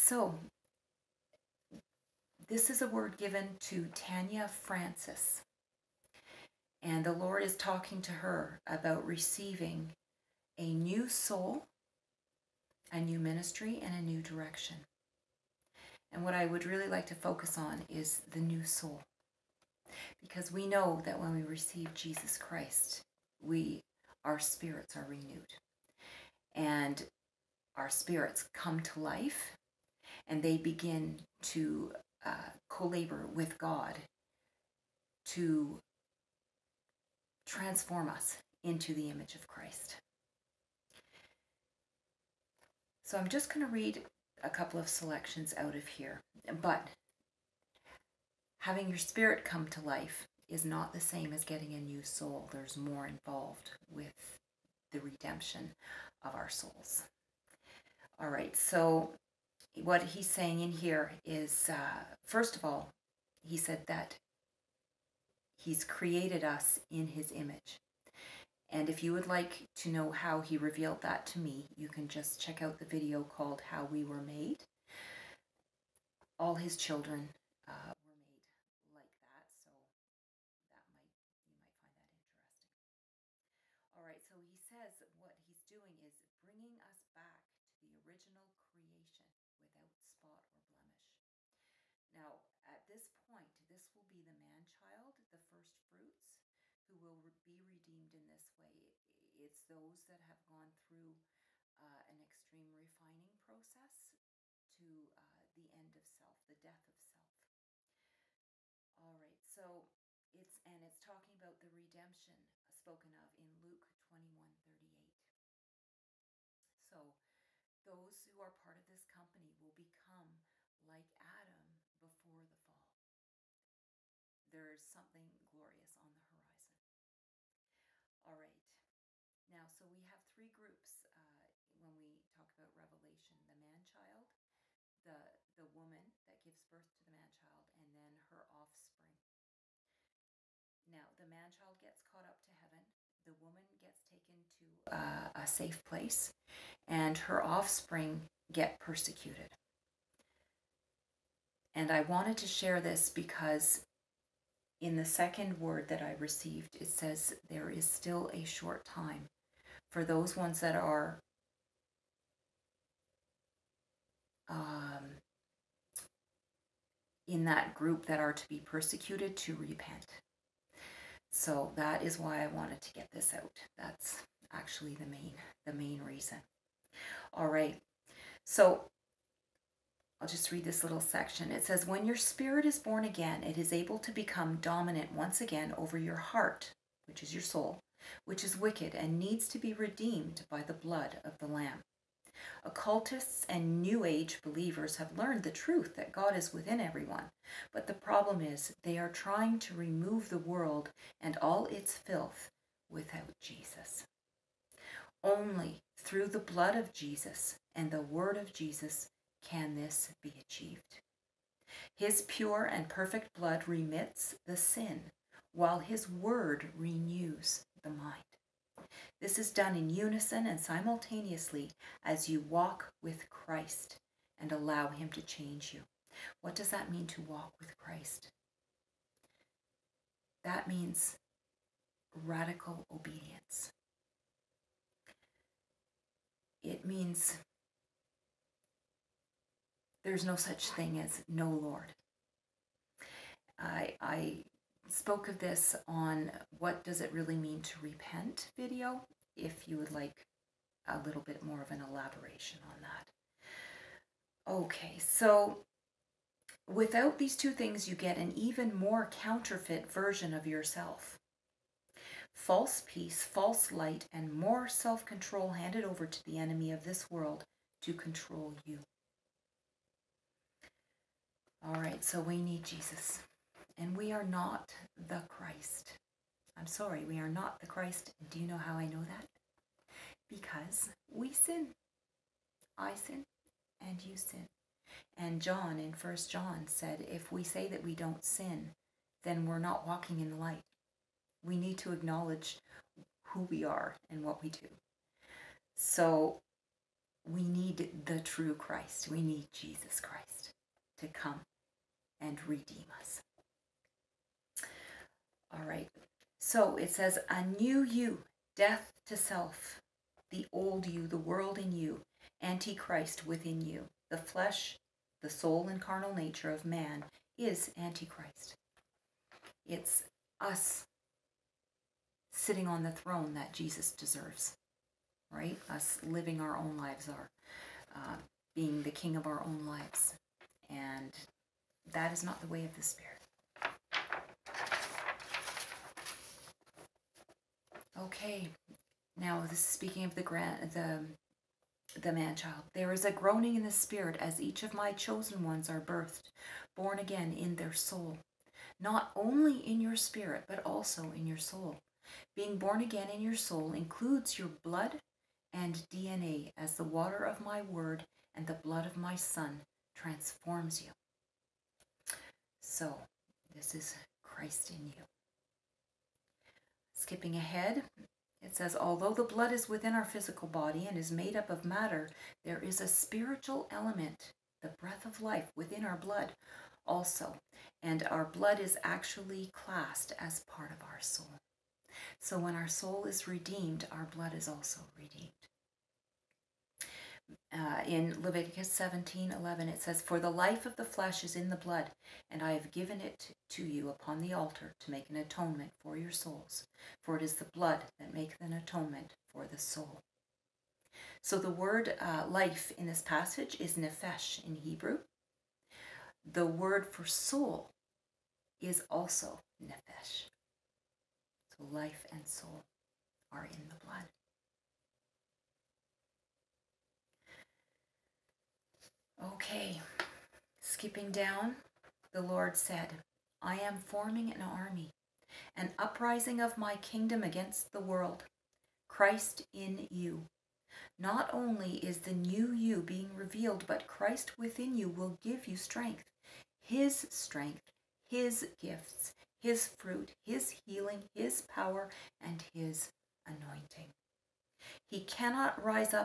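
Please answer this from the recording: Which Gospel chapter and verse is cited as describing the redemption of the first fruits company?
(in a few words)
Luke 21:38.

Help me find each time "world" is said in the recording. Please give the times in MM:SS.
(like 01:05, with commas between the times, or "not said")
03:20, 04:27, 05:11, 07:07.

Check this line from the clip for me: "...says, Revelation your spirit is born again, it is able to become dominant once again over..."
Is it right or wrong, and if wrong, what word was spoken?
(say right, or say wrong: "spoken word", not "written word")
wrong: "When", not "Revelation".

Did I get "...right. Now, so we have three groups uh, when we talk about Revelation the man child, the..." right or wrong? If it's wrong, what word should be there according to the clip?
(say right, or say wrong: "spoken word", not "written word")
right.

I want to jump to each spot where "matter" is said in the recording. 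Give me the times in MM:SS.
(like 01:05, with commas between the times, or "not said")
06:11.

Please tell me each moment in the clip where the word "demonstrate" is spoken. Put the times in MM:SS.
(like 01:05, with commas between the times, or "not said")
not said.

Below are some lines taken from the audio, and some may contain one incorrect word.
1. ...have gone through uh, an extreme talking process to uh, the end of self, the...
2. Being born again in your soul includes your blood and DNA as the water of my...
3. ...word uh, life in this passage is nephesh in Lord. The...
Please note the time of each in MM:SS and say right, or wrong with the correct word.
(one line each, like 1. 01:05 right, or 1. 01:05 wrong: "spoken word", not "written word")
1. 01:40 wrong: "refining", not "talking"
2. 05:52 right
3. 06:41 wrong: "Hebrew", not "Lord".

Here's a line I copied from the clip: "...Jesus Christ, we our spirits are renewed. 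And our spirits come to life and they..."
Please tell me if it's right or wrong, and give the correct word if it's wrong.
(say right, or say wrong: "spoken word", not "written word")
right.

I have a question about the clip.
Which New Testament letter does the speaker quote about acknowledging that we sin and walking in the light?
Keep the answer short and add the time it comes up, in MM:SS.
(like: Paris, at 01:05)
First John, at 04:45.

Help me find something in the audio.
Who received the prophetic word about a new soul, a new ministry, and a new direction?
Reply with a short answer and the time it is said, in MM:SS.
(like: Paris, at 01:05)
Tanya Francis, at 00:03.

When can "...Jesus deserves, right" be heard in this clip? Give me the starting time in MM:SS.
05:23.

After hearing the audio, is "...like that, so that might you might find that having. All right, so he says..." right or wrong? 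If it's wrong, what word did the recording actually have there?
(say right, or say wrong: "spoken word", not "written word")
wrong: "interesting", not "having".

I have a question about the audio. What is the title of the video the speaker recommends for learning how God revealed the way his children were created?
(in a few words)
How We Were Made.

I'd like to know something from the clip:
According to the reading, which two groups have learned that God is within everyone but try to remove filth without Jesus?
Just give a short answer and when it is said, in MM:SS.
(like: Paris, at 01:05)
Occultists and New Age believers, at 03:12.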